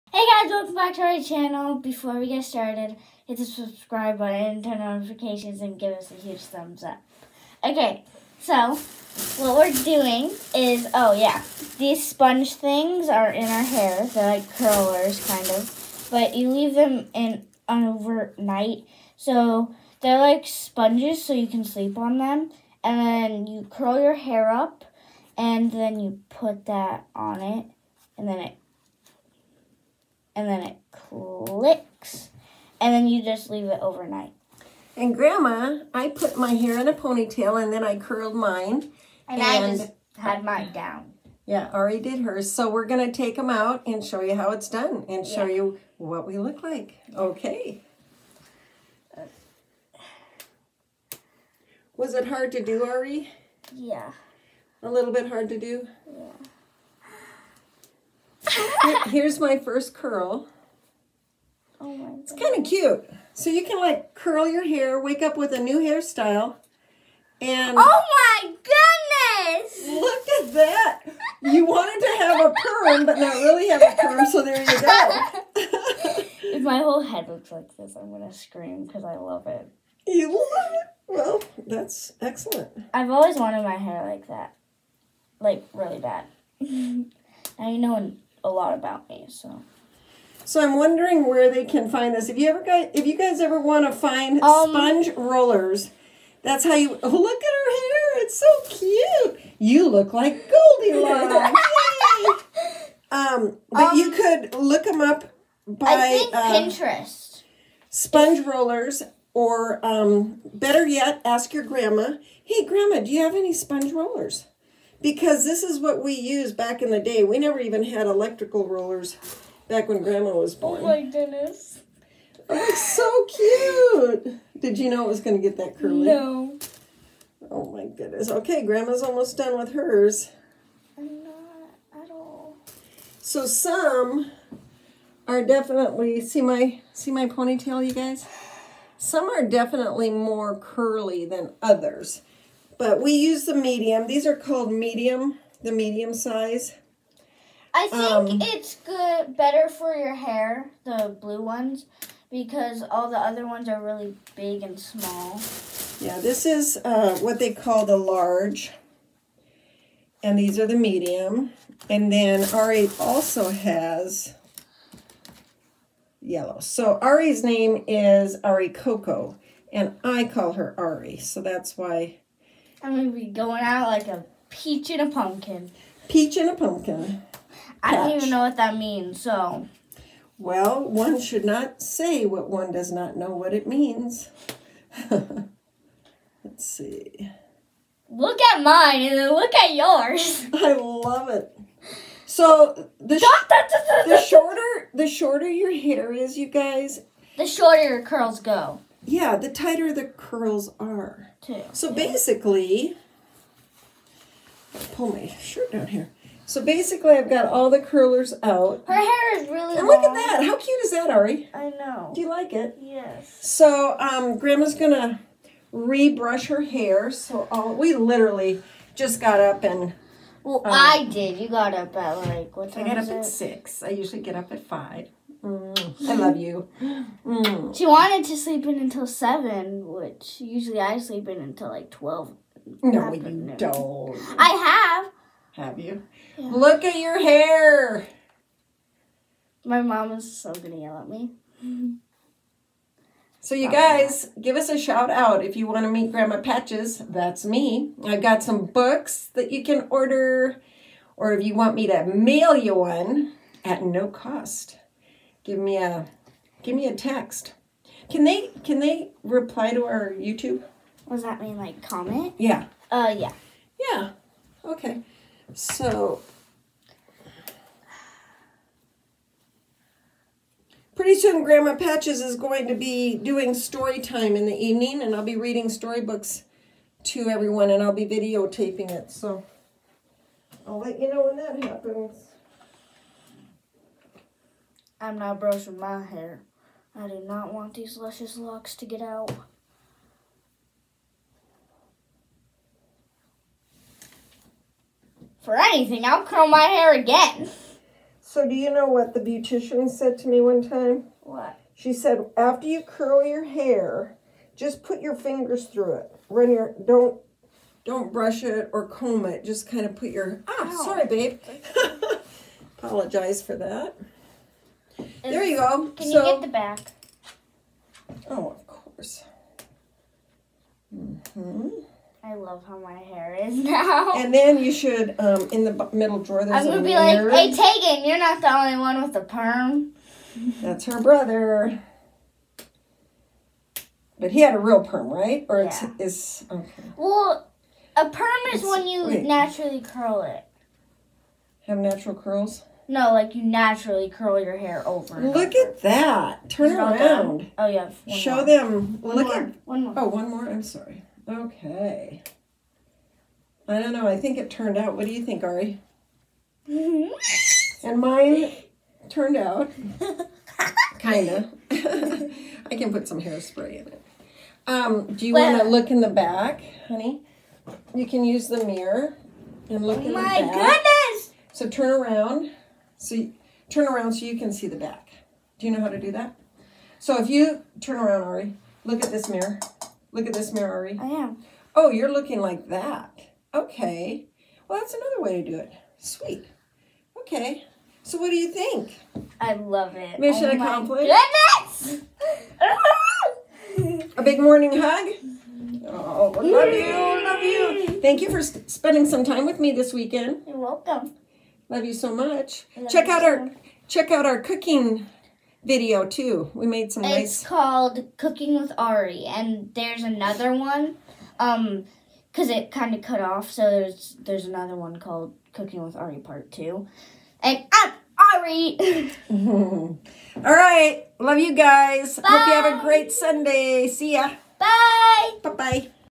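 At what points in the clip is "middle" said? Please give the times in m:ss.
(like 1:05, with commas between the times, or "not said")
5:25.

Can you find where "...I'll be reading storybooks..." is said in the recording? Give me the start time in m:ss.
4:35.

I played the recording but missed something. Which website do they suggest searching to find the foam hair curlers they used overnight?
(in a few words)
Pinterest.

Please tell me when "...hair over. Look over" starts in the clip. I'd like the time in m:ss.
5:44.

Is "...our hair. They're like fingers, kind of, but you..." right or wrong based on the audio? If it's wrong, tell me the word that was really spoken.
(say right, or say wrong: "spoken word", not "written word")
wrong: "curlers", not "fingers".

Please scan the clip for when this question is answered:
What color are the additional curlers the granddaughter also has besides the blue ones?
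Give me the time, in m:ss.
2:46.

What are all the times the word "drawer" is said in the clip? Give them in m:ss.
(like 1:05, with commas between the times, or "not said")
5:26.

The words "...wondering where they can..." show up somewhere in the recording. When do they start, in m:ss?
1:30.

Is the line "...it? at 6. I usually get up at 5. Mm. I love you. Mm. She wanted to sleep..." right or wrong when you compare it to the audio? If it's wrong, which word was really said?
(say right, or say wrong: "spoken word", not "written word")
right.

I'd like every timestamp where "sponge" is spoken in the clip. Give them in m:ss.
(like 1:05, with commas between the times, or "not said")
0:12, 0:20, 1:34, 1:47, 1:53.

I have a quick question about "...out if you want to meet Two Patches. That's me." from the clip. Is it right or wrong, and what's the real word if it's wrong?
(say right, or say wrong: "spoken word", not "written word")
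wrong: "Grandma", not "Two".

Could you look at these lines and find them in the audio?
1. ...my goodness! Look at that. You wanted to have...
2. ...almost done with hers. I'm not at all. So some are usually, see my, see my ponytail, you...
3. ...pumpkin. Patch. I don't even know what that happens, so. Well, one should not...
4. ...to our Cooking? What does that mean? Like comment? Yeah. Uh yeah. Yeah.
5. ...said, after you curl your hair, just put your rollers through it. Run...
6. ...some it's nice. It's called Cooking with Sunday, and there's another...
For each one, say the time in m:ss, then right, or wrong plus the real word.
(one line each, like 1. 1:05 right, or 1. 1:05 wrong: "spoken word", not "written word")
1. 1:08 right
2. 2:09 wrong: "definitely", not "usually"
3. 2:56 wrong: "means", not "happens"
4. 4:19 wrong: "YouTube", not "Cooking"
5. 5:01 wrong: "fingers", not "rollers"
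6. 6:46 wrong: "Ari", not "Sunday".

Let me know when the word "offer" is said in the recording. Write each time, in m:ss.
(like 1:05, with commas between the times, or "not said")
not said.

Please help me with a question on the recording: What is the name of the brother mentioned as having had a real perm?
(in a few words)
Tegan.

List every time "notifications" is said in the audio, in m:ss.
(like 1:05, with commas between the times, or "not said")
0:05.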